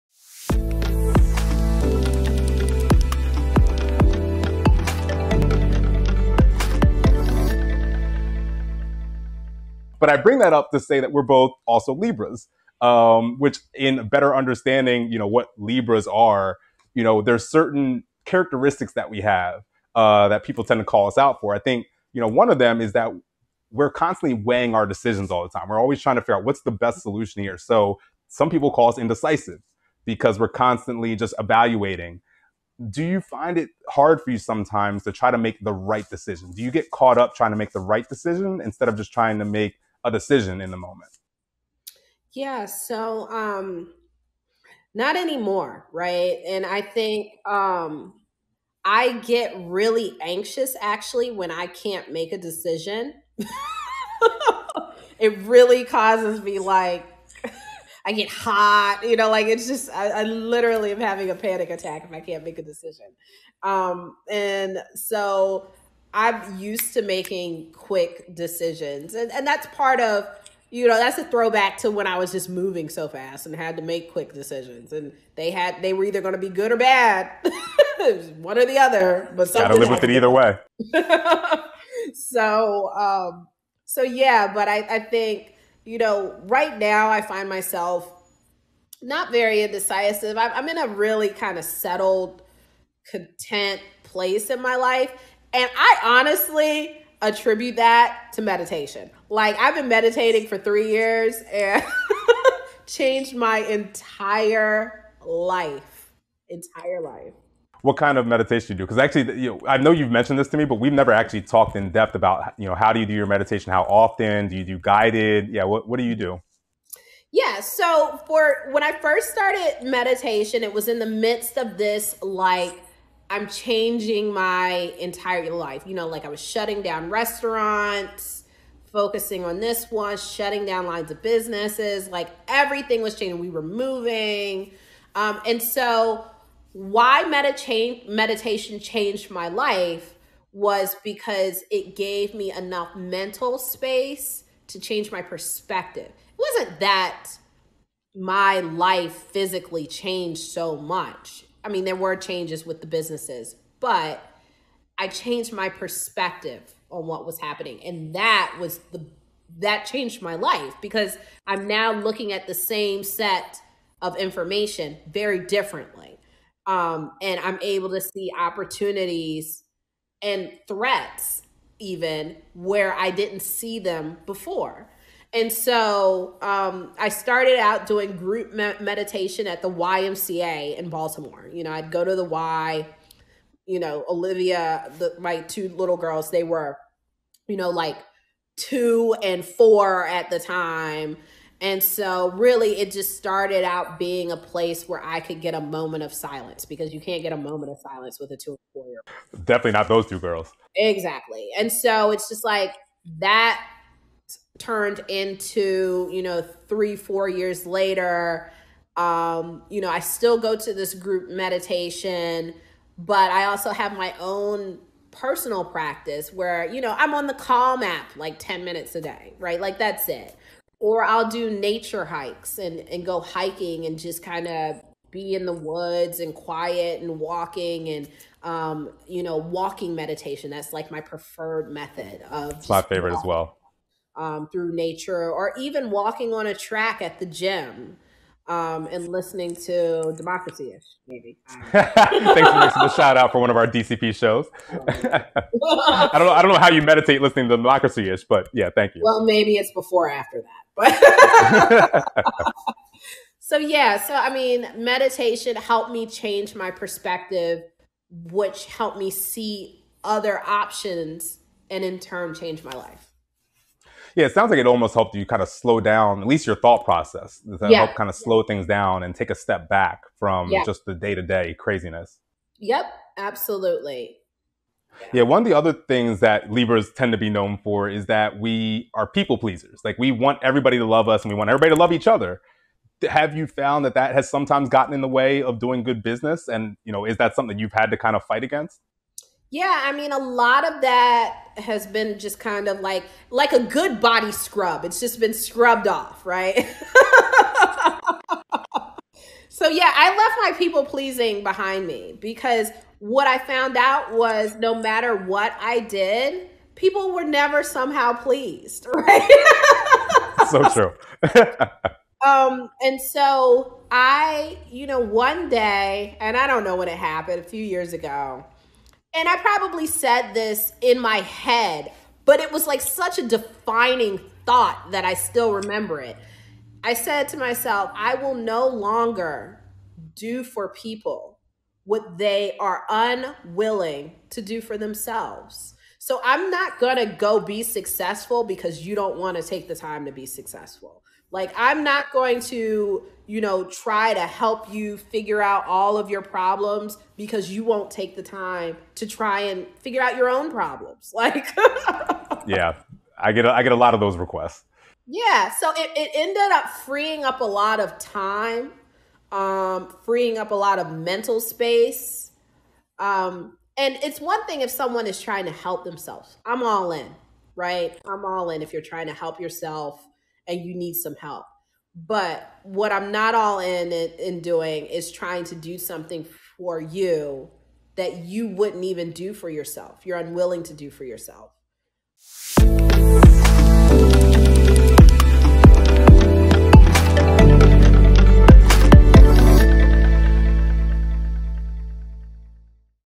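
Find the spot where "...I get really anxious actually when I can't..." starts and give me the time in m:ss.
0:48.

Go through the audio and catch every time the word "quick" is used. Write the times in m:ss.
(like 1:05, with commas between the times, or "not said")
1:07, 1:14.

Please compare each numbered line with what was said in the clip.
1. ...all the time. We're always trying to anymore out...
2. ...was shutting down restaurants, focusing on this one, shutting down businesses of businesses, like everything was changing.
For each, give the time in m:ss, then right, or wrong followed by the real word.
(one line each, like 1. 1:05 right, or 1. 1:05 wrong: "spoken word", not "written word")
1. 0:25 wrong: "figure", not "anymore"
2. 2:06 wrong: "lines", not "businesses".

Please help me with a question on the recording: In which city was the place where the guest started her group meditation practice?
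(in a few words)
Baltimore.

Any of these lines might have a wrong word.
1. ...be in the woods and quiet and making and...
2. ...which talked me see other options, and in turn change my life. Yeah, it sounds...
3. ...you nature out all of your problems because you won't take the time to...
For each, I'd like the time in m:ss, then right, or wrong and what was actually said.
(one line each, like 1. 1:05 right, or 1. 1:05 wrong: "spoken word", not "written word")
1. 3:45 wrong: "walking", not "making"
2. 4:18 wrong: "helped", not "talked"
3. 5:44 wrong: "figure", not "nature".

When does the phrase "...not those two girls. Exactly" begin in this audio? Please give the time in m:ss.
3:19.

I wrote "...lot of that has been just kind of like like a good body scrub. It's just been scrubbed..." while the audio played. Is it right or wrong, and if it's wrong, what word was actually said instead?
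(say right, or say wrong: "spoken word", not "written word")
right.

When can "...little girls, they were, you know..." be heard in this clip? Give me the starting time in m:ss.
3:05.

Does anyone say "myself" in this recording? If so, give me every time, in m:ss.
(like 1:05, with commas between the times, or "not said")
1:27, 5:27.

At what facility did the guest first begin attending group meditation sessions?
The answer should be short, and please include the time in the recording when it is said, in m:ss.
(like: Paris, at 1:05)
YMCA, at 2:59.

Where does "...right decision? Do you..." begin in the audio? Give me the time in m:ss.
0:35.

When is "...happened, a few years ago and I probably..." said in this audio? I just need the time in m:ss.
5:16.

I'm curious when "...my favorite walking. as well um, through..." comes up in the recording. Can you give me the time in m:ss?
3:52.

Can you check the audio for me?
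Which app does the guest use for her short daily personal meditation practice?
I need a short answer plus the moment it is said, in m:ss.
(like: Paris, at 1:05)
Calm, at 3:37.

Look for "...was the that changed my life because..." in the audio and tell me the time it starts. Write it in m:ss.
2:38.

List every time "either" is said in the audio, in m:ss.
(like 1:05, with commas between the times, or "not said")
1:16, 1:20.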